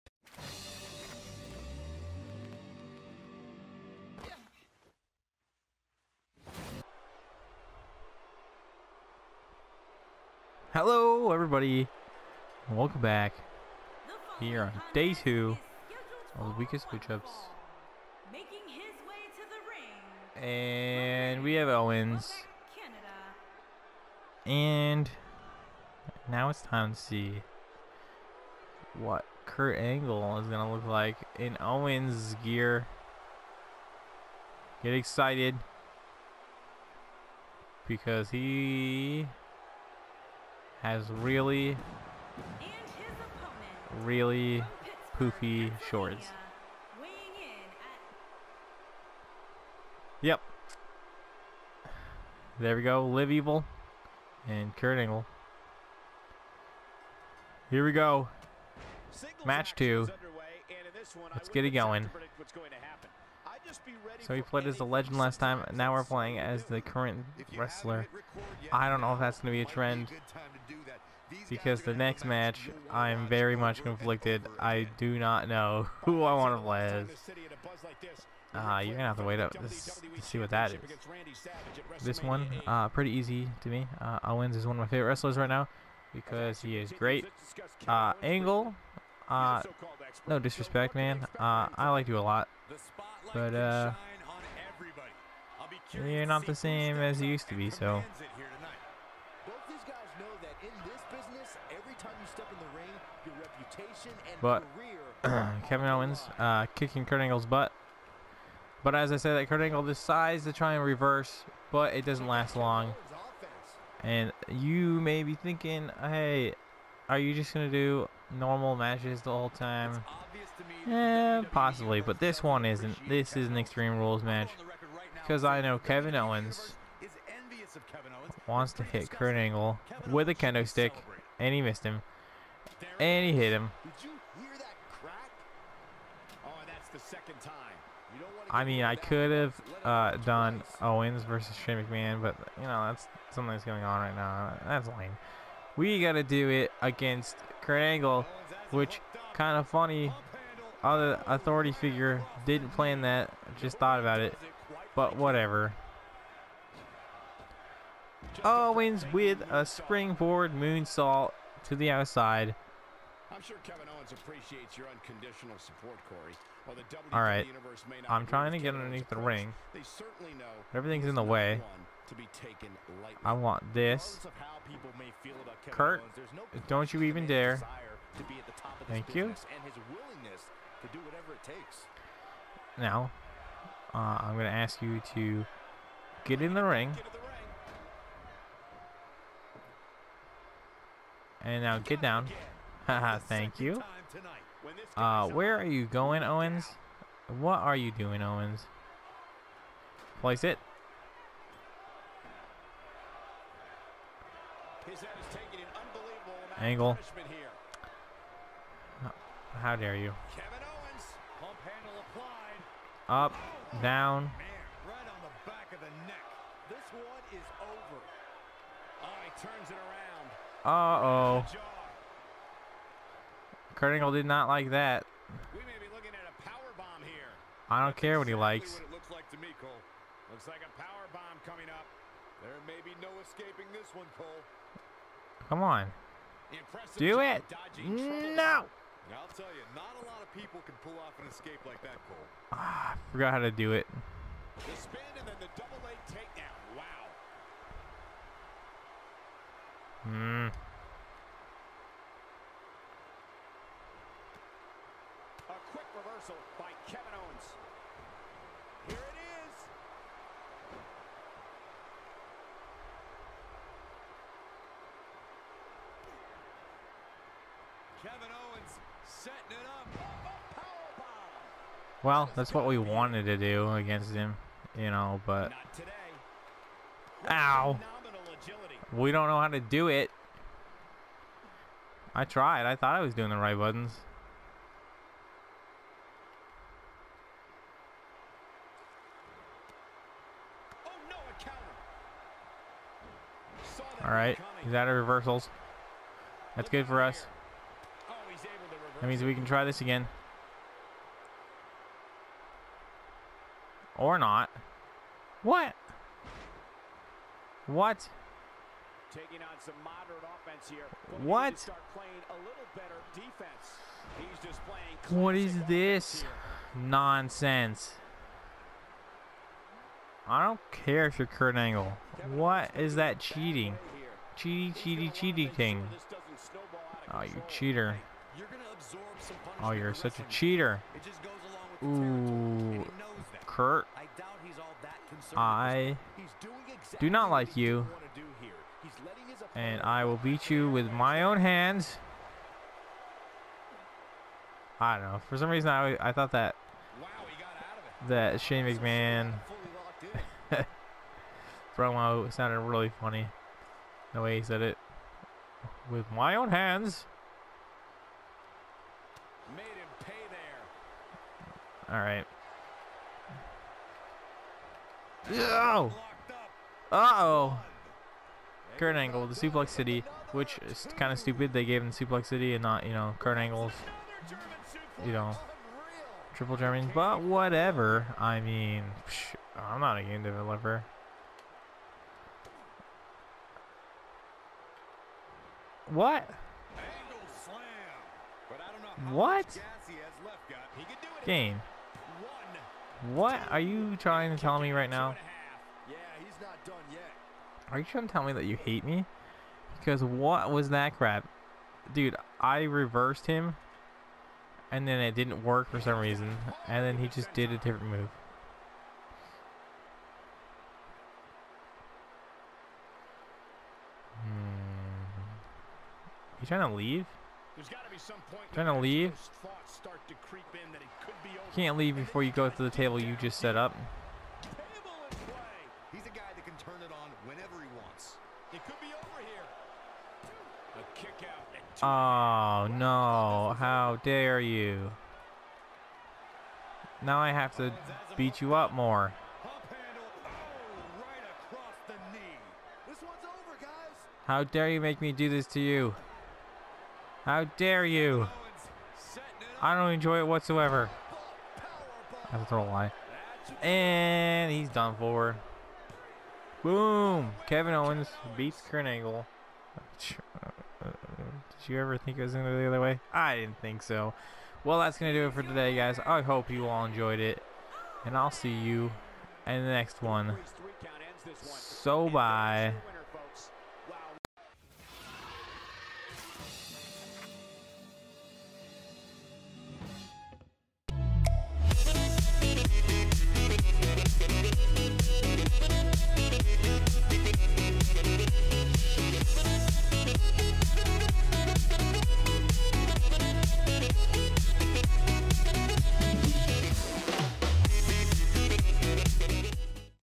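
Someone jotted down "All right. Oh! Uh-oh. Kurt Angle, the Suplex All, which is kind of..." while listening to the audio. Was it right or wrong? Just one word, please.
wrong.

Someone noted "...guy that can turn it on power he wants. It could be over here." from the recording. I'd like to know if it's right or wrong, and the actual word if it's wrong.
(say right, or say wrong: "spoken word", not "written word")
wrong: "whenever", not "power".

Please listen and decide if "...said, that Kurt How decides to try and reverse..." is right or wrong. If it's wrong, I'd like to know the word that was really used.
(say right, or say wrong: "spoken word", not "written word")
wrong: "Angle", not "How".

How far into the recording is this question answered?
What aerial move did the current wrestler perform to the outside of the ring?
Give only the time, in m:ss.
2:39.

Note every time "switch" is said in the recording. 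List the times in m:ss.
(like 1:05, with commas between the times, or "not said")
0:16.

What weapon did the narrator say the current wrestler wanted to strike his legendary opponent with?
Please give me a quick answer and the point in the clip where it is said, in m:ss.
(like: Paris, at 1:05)
Kendo stick, at 2:10.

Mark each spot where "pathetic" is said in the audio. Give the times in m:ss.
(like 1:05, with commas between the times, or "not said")
not said.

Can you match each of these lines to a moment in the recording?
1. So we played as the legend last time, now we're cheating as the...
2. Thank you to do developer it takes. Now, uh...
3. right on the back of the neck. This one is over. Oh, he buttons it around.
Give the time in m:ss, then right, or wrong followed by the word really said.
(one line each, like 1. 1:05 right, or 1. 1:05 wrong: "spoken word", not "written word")
1. 1:04 wrong: "playing", not "cheating"
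2. 2:58 wrong: "whatever", not "developer"
3. 3:34 wrong: "turns", not "buttons".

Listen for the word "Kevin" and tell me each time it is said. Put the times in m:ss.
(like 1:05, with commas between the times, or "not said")
1:45, 2:05, 2:43, 3:30, 4:16, 4:28, 7:37.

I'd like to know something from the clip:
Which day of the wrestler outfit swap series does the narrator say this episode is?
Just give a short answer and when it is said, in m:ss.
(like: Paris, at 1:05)
Day two, at 0:14.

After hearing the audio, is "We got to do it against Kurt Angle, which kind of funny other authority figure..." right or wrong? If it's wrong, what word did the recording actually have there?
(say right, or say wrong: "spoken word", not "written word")
right.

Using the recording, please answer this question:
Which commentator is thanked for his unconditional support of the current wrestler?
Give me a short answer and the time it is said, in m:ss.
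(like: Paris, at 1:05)
Corey, at 2:46.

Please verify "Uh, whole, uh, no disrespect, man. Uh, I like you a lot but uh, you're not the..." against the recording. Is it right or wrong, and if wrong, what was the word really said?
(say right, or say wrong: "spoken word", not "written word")
wrong: "angle", not "whole".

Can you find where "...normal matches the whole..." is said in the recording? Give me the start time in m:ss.
1:58.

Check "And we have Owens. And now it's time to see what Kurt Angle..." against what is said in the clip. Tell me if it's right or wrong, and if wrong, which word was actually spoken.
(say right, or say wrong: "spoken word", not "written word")
right.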